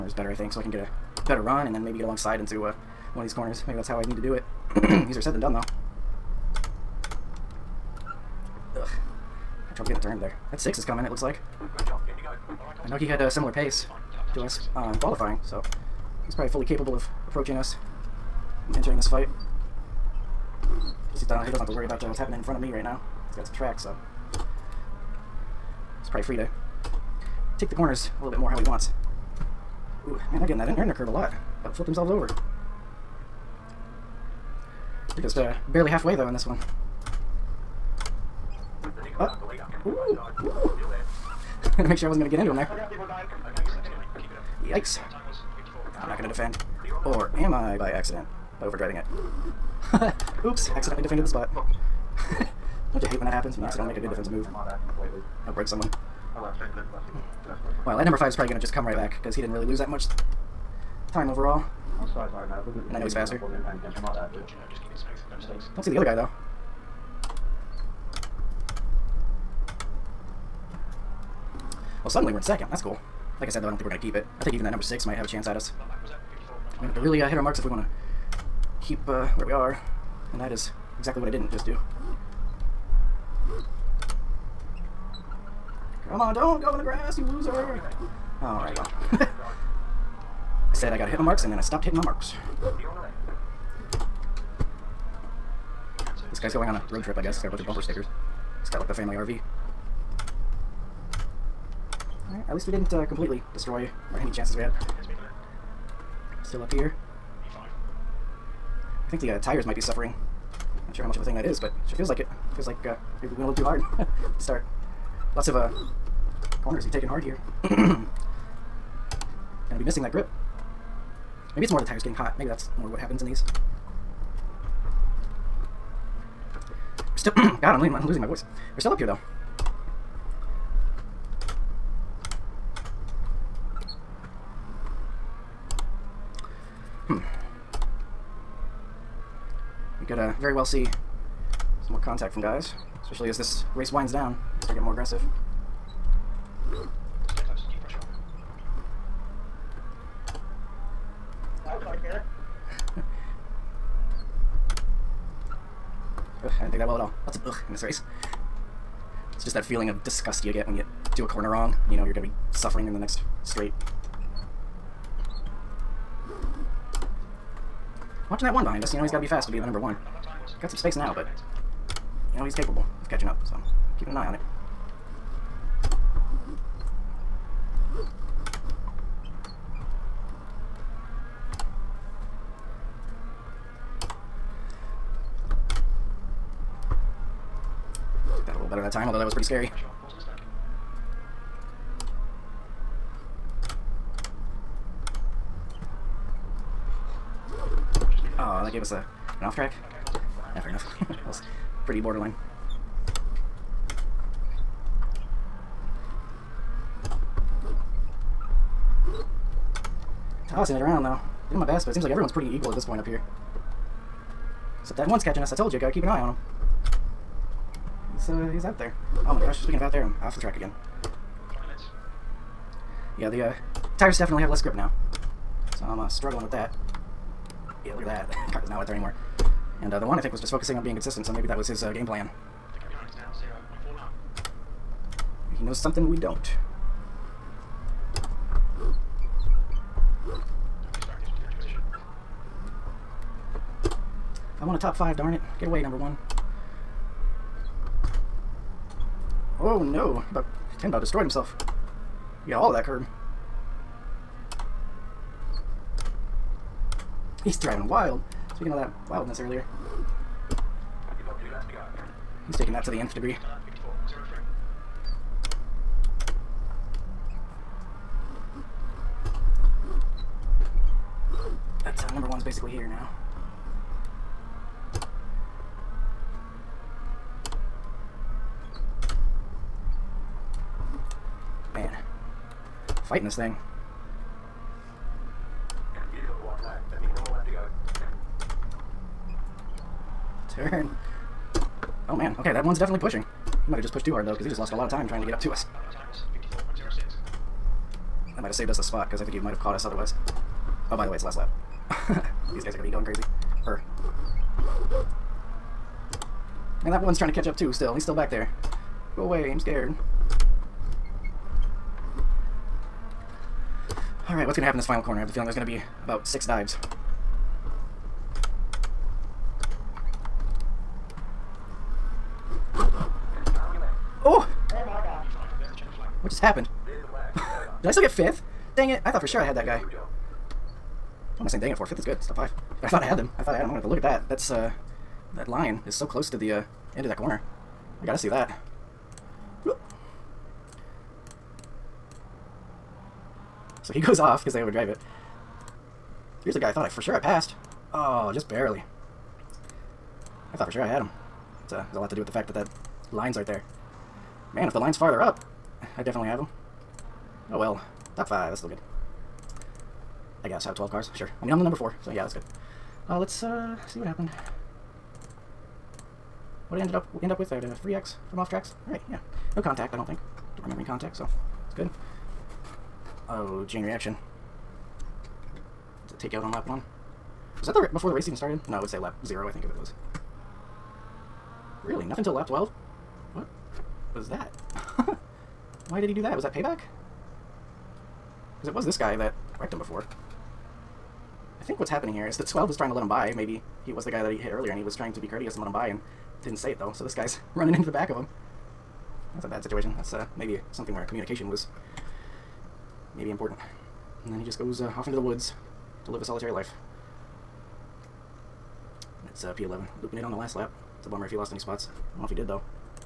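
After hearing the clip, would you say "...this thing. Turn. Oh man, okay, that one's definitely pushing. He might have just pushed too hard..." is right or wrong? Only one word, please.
right.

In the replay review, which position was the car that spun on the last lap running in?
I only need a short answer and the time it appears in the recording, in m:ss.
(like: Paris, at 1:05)
P11, at 6:49.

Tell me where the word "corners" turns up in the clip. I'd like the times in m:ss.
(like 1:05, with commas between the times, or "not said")
0:03, 0:27, 1:56, 2:41, 5:15, 5:37.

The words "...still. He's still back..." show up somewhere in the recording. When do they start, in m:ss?
5:07.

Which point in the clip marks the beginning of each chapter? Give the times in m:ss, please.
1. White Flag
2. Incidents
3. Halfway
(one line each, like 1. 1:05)
1. 4:51
2. 6:09
3. 0:08.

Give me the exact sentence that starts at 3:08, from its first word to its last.
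time, although that was pretty scary.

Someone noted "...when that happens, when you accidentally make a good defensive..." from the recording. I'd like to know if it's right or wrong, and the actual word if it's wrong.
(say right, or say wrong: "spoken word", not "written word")
right.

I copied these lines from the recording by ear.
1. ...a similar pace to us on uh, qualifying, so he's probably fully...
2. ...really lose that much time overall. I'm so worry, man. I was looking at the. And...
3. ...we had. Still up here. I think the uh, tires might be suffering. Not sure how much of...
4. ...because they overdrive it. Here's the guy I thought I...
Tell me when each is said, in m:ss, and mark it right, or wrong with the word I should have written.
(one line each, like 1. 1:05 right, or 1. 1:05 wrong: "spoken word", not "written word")
1. 0:13 right
2. 0:59 wrong: "sorry", not "worry"
3. 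1:44 right
4. 5:44 right.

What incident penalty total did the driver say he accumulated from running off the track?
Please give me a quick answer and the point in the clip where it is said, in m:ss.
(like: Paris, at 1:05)
3x, at 6:07.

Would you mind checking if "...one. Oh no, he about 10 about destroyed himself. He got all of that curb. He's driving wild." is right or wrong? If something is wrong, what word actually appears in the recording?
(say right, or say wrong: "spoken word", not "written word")
right.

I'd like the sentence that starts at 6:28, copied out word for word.
Because it was this guy that wrecked him before.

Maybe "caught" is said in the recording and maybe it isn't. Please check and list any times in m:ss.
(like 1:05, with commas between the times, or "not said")
4:59.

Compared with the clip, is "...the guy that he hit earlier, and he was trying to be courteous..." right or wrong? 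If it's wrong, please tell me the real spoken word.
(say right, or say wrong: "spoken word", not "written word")
right.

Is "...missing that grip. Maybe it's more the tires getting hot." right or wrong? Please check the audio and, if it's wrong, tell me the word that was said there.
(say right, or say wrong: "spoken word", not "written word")
right.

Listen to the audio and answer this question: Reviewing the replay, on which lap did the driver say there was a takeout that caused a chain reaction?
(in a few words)
lap one.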